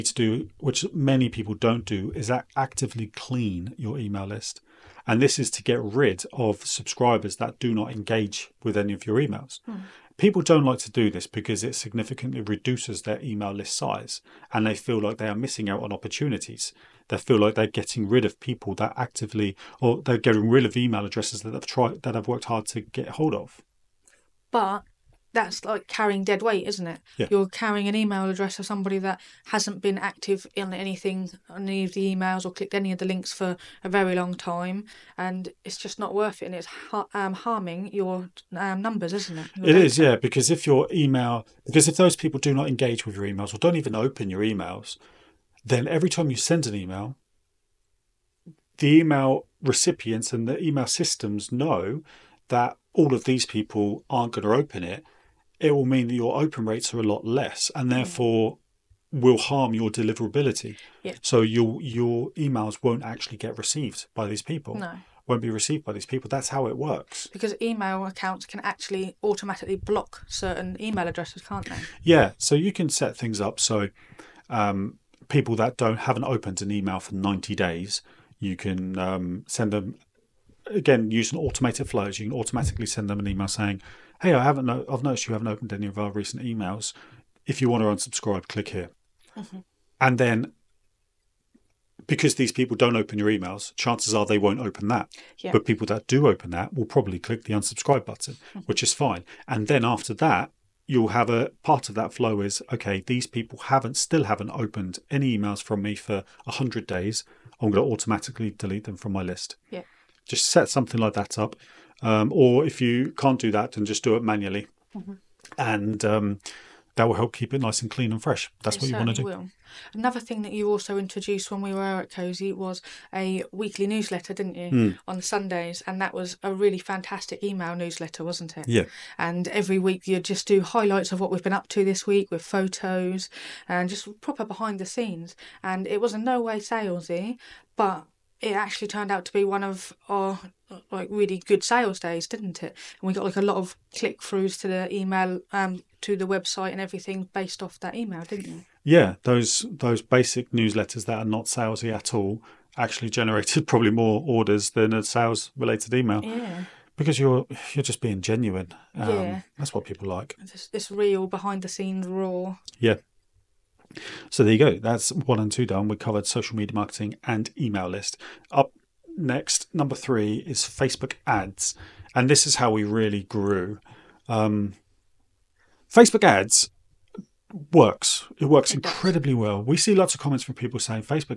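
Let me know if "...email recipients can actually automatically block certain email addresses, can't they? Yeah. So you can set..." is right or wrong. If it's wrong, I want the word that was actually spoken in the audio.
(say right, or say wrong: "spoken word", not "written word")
wrong: "accounts", not "recipients".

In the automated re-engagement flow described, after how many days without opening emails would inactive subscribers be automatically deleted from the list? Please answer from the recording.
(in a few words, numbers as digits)
100.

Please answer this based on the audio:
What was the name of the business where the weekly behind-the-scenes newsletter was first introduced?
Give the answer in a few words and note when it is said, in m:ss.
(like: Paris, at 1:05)
Cozy, at 2:02.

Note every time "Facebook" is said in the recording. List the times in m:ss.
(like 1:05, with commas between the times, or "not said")
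2:50, 2:55.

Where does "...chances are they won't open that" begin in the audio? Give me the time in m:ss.
1:33.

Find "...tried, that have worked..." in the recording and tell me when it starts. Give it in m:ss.
0:21.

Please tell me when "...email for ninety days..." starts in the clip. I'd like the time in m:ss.
1:16.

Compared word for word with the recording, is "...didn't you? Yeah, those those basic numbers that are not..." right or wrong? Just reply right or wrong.
wrong.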